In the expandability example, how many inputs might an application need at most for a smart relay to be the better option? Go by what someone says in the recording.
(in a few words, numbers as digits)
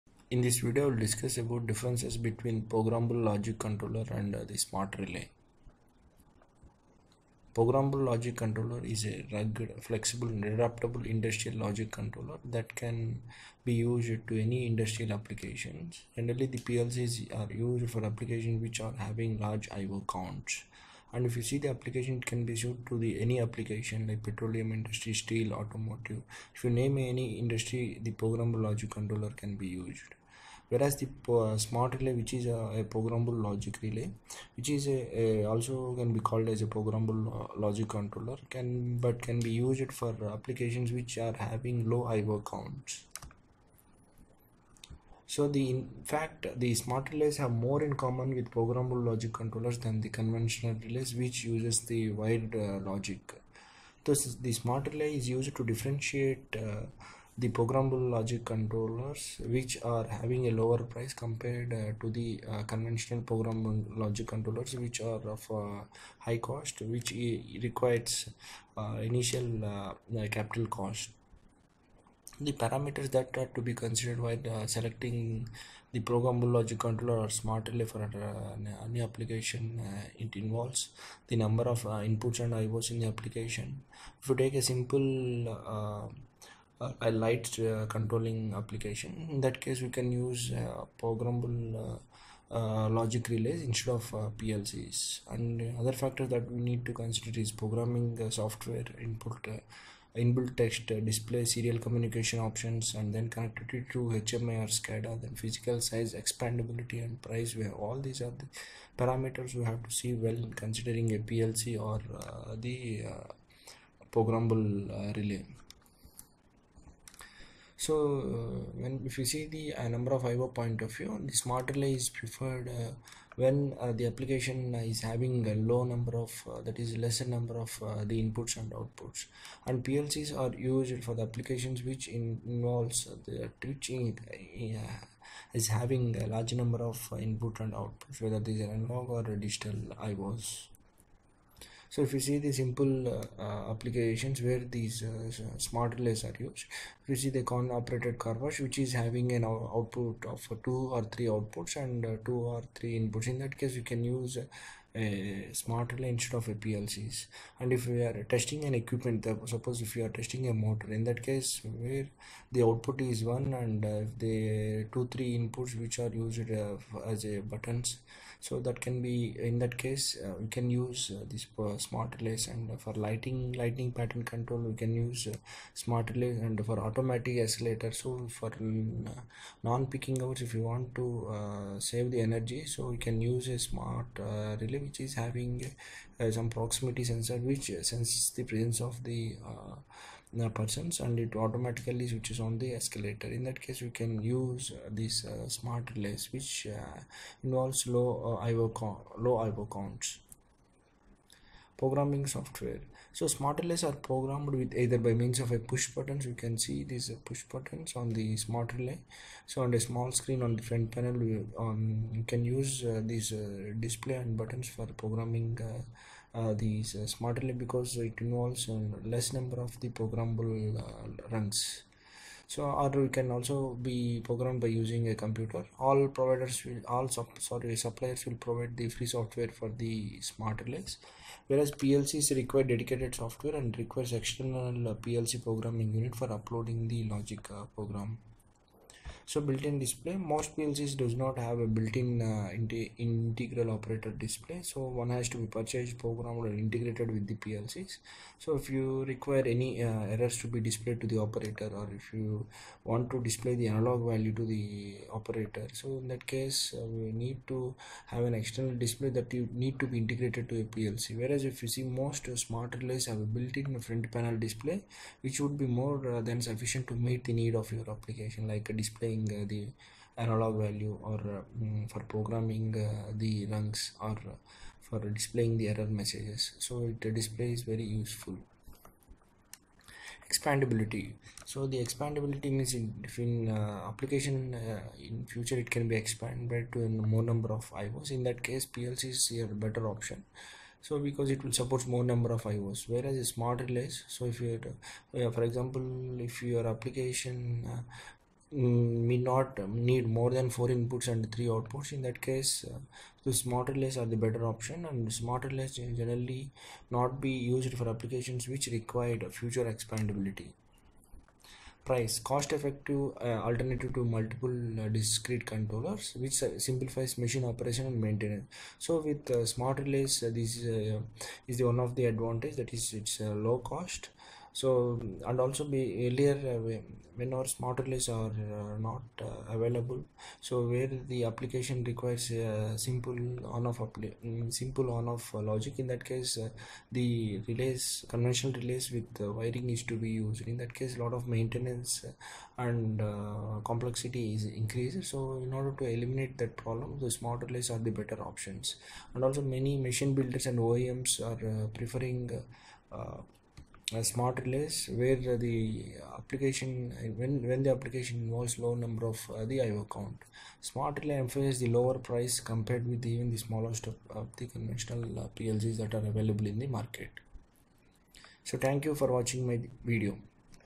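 4.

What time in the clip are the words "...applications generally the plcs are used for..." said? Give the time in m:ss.
0:15.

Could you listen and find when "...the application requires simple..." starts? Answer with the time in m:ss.
5:31.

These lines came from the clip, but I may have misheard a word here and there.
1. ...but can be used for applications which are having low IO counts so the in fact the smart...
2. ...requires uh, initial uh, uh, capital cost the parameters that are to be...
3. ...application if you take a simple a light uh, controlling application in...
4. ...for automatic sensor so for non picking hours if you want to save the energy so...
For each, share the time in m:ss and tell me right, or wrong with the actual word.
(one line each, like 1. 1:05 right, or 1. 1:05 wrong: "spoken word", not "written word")
1. 0:38 right
2. 1:07 right
3. 1:23 right
4. 2:56 wrong: "escalator", not "sensor".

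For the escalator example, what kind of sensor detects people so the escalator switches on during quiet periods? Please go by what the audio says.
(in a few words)
proximity sensor.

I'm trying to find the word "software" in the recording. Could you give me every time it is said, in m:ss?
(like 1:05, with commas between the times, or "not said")
1:38, 3:22, 3:49, 3:53.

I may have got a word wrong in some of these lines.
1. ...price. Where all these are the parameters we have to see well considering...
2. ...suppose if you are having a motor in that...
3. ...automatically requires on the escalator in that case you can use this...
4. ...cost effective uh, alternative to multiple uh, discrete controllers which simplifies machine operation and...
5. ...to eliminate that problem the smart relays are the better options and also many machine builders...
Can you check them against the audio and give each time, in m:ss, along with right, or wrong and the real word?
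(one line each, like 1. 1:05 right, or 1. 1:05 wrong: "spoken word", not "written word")
1. 1:47 right
2. 2:39 wrong: "testing", not "having"
3. 3:11 wrong: "switches", not "requires"
4. 5:12 right
5. 5:45 right.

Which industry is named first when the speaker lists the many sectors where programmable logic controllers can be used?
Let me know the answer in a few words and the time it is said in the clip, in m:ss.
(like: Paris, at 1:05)
petroleum industry, at 0:24.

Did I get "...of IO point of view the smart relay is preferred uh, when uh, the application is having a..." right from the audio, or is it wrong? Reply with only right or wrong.
right.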